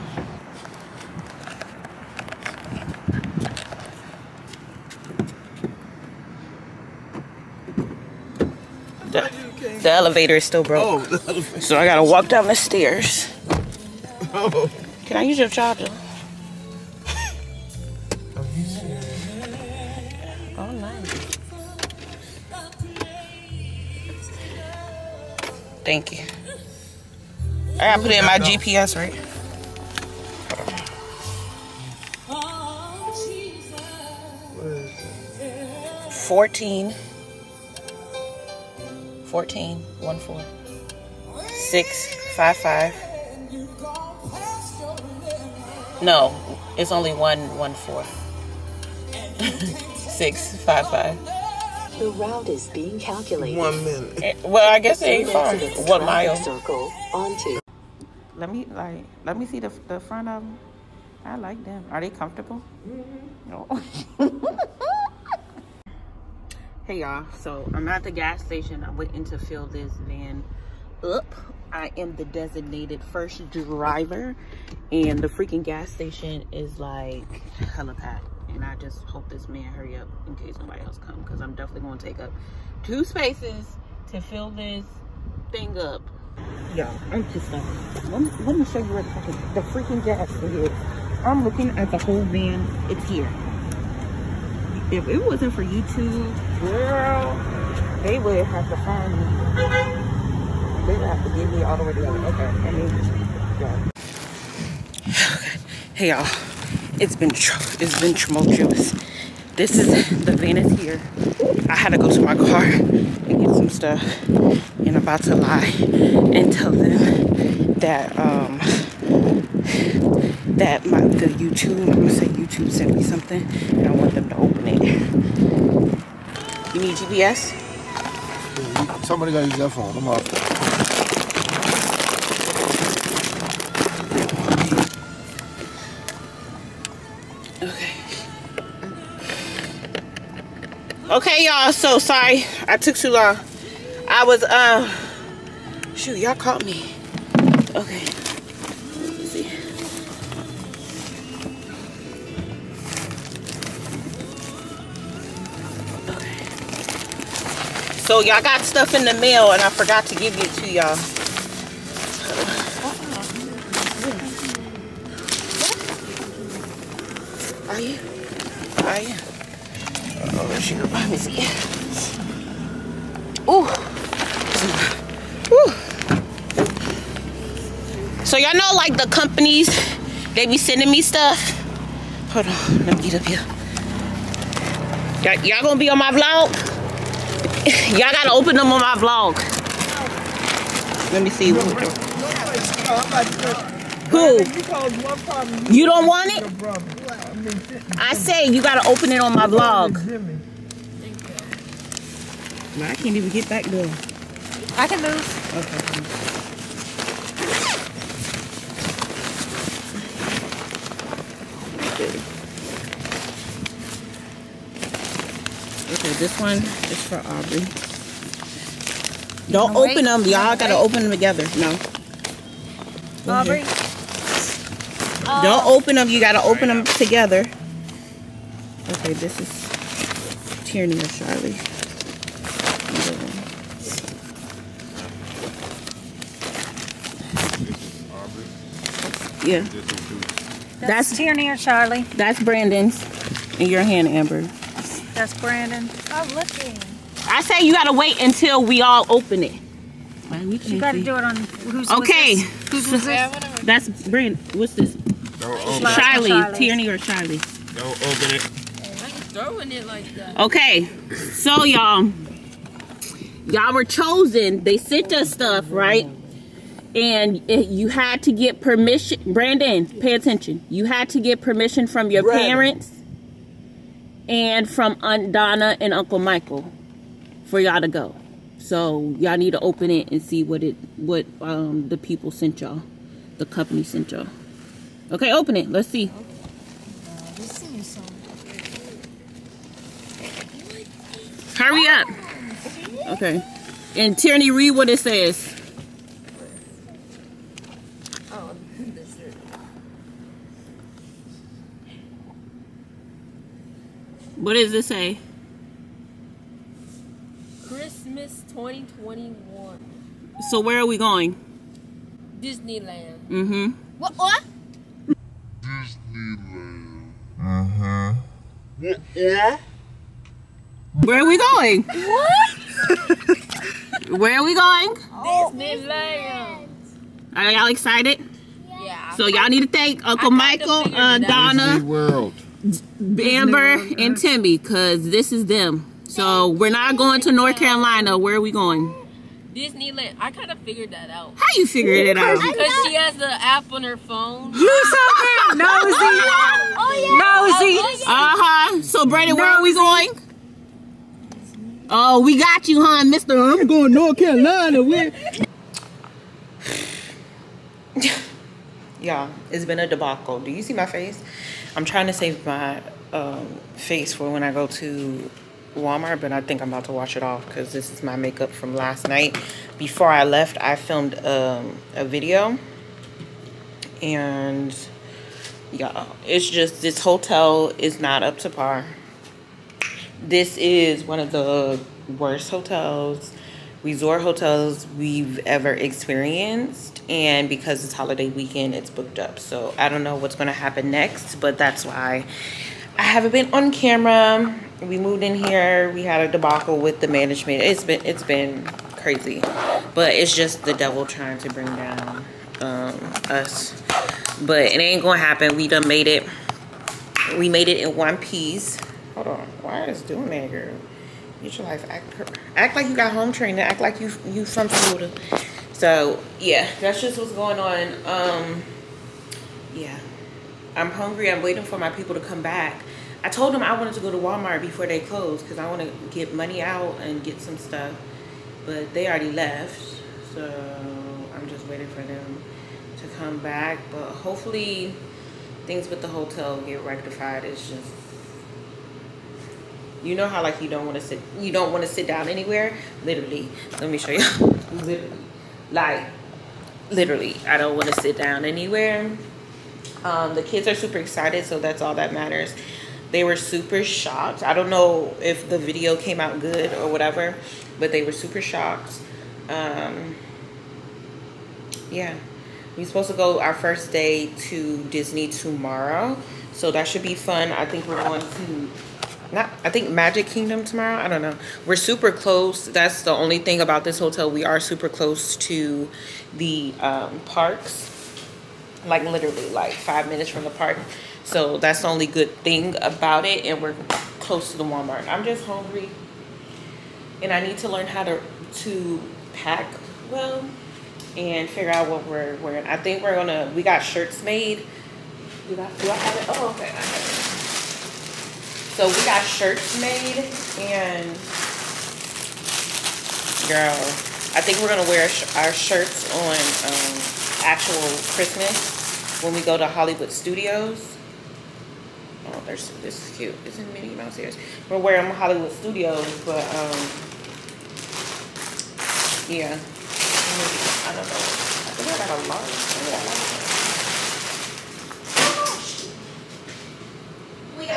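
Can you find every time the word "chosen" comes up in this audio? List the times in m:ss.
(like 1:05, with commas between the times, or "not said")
4:23.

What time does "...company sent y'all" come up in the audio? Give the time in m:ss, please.
4:43.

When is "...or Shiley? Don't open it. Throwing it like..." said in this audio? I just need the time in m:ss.
4:16.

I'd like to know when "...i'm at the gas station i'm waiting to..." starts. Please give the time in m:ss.
1:07.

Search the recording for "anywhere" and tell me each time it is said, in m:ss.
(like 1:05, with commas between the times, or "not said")
7:22, 7:28.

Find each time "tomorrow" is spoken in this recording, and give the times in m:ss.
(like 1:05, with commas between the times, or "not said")
7:45, 7:50.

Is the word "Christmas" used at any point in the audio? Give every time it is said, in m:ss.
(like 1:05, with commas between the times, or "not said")
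5:07, 8:28.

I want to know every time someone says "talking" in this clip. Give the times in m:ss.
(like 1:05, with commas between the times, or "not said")
not said.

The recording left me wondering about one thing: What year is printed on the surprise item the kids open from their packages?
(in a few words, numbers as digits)
2021.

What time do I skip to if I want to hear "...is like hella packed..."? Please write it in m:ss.
1:16.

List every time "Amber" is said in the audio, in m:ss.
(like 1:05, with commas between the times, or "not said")
4:04, 5:33.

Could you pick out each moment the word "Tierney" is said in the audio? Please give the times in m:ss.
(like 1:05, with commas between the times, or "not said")
3:50, 4:01, 4:16, 4:54.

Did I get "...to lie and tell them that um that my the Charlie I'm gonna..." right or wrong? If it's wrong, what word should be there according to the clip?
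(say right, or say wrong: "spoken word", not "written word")
wrong: "YouTube", not "Charlie".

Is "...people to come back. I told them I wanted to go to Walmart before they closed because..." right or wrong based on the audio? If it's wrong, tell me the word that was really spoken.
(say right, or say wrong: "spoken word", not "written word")
right.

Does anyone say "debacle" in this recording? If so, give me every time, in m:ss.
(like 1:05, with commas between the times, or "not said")
5:59, 6:36.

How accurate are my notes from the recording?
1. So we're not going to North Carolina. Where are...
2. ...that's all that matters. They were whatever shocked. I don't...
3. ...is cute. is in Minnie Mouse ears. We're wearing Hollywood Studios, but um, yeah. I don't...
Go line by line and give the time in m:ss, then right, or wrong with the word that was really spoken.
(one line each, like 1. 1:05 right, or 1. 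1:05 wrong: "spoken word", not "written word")
1. 5:36 right
2. 7:31 wrong: "super", not "whatever"
3. 8:33 right.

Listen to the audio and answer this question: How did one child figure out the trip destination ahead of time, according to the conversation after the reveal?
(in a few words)
the app on her phone.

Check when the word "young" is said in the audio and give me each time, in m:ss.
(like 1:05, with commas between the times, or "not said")
not said.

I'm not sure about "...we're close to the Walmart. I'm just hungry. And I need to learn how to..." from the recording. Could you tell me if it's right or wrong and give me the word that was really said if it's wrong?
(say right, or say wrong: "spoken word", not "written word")
right.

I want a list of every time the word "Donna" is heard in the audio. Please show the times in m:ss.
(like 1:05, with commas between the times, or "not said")
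4:35, 5:31.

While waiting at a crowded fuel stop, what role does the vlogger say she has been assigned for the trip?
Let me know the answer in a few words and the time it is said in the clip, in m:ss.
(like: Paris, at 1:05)
designated first driver, at 1:12.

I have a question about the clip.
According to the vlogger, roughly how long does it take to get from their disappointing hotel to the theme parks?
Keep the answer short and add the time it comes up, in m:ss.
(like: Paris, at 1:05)
5 minutes, at 7:59.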